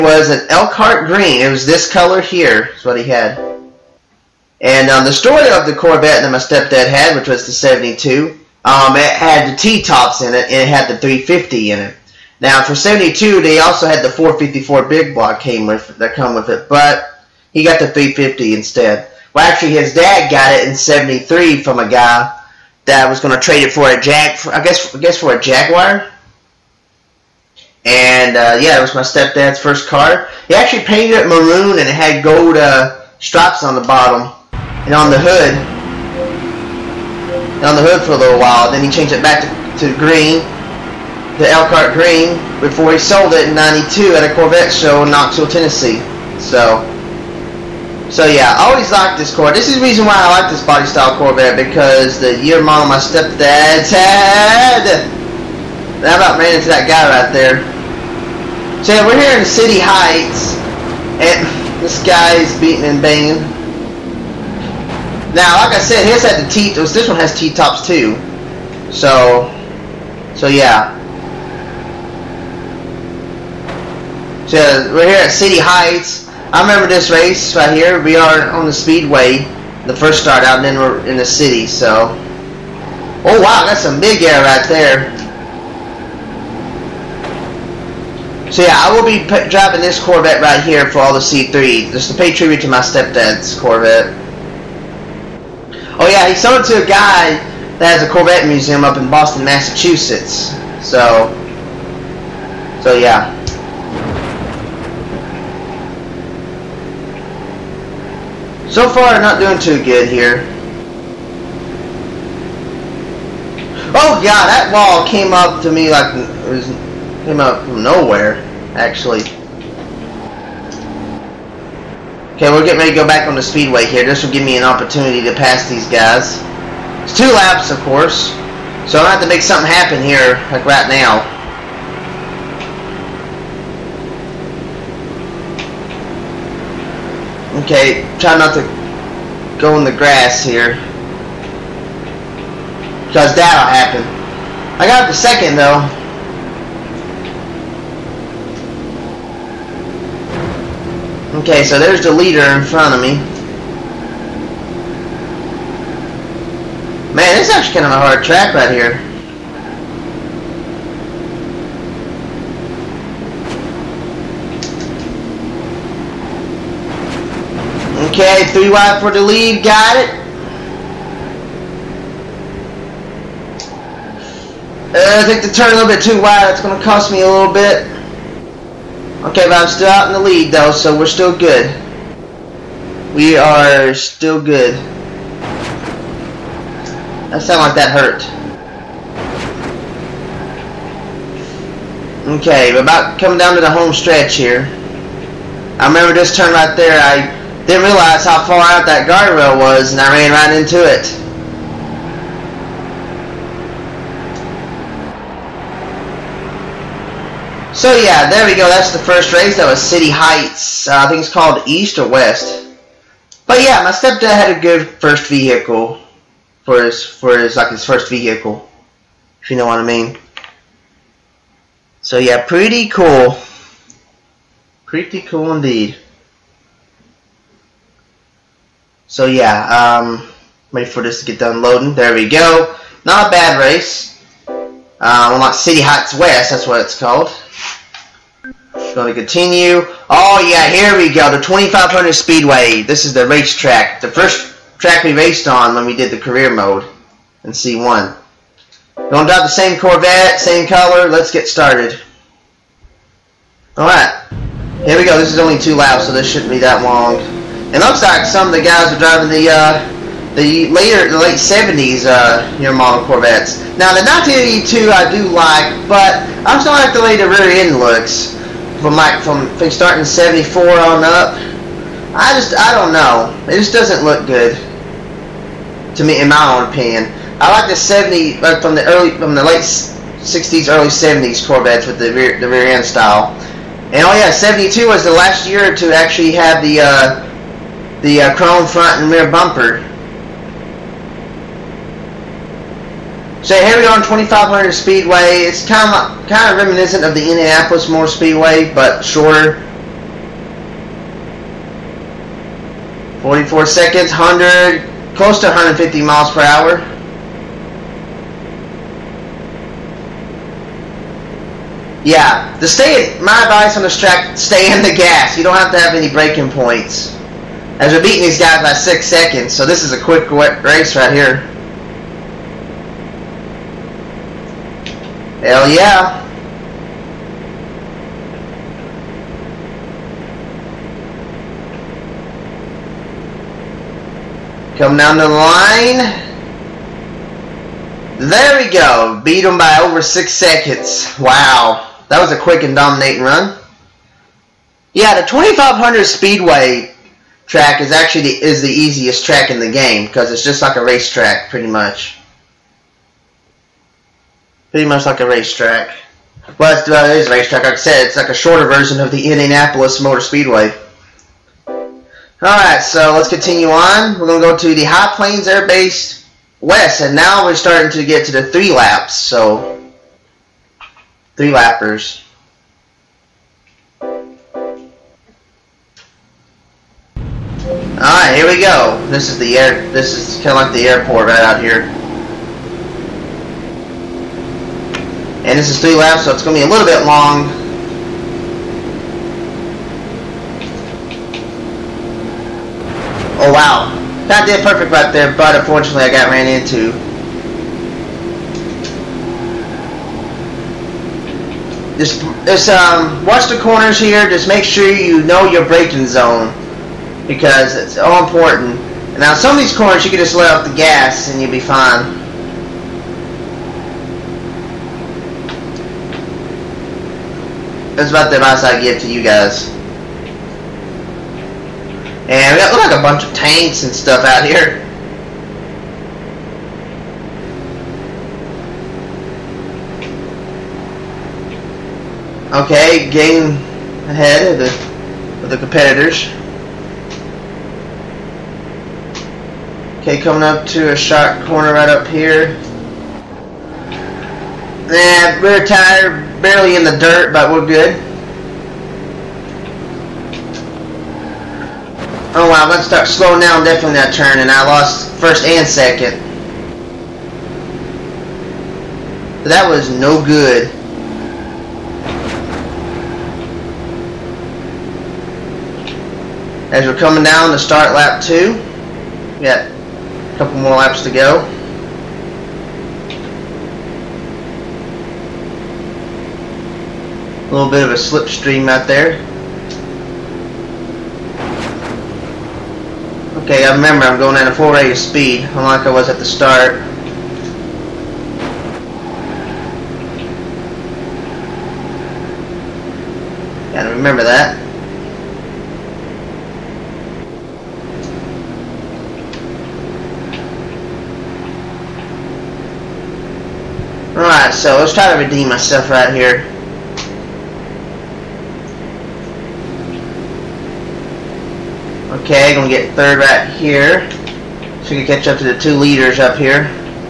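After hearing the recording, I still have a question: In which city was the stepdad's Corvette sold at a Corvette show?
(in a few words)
Knoxville, Tennessee.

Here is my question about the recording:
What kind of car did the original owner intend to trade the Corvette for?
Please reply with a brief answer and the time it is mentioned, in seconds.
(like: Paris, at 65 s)
Jaguar, at 25 s.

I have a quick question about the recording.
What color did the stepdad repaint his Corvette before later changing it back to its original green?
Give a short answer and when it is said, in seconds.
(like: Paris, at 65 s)
Maroon, at 31 s.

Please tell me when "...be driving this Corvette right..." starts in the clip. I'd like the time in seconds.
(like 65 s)
89 s.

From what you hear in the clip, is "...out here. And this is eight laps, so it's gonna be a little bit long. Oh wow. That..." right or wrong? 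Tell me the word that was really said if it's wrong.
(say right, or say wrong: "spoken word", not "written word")
wrong: "three", not "eight".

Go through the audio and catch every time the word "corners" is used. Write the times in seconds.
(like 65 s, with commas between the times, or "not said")
403 s, 409 s, 441 s.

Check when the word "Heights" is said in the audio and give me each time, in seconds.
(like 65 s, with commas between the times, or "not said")
59 s, 75 s, 210 s, 235 s.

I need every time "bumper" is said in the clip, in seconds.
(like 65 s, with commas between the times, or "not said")
289 s.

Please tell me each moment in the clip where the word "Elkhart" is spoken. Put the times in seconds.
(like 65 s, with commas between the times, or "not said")
0 s, 41 s.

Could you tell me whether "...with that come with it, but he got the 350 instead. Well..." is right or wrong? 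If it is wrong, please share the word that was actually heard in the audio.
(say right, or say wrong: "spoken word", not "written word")
right.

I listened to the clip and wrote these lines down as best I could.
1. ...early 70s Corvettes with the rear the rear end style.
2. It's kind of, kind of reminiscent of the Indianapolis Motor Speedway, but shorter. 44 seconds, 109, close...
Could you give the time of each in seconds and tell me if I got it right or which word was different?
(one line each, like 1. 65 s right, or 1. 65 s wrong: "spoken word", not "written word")
1. 280 s right
2. 295 s wrong: "100", not "109".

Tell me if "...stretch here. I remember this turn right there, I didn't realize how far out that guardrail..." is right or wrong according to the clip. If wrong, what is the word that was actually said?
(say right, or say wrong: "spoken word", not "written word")
right.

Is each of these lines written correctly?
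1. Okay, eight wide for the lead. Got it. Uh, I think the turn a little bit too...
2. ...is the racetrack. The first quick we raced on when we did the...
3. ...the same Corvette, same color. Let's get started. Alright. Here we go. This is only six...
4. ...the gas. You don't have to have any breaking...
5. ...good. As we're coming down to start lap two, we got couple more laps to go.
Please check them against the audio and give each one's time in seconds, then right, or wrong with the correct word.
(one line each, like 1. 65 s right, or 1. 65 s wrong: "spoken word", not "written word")
1. 168 s wrong: "three", not "eight"
2. 243 s wrong: "track", not "quick"
3. 249 s wrong: "two", not "six"
4. 314 s right
5. 460 s right.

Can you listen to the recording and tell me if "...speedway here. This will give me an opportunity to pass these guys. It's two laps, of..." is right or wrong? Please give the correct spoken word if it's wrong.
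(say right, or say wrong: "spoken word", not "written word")
right.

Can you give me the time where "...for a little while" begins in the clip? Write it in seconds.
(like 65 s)
38 s.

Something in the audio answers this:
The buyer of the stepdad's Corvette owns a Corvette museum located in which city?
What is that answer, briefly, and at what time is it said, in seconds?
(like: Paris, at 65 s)
Boston, at 99 s.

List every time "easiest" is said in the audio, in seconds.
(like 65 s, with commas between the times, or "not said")
348 s.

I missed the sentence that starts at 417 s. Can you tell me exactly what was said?
That's about the advice I give to you guys.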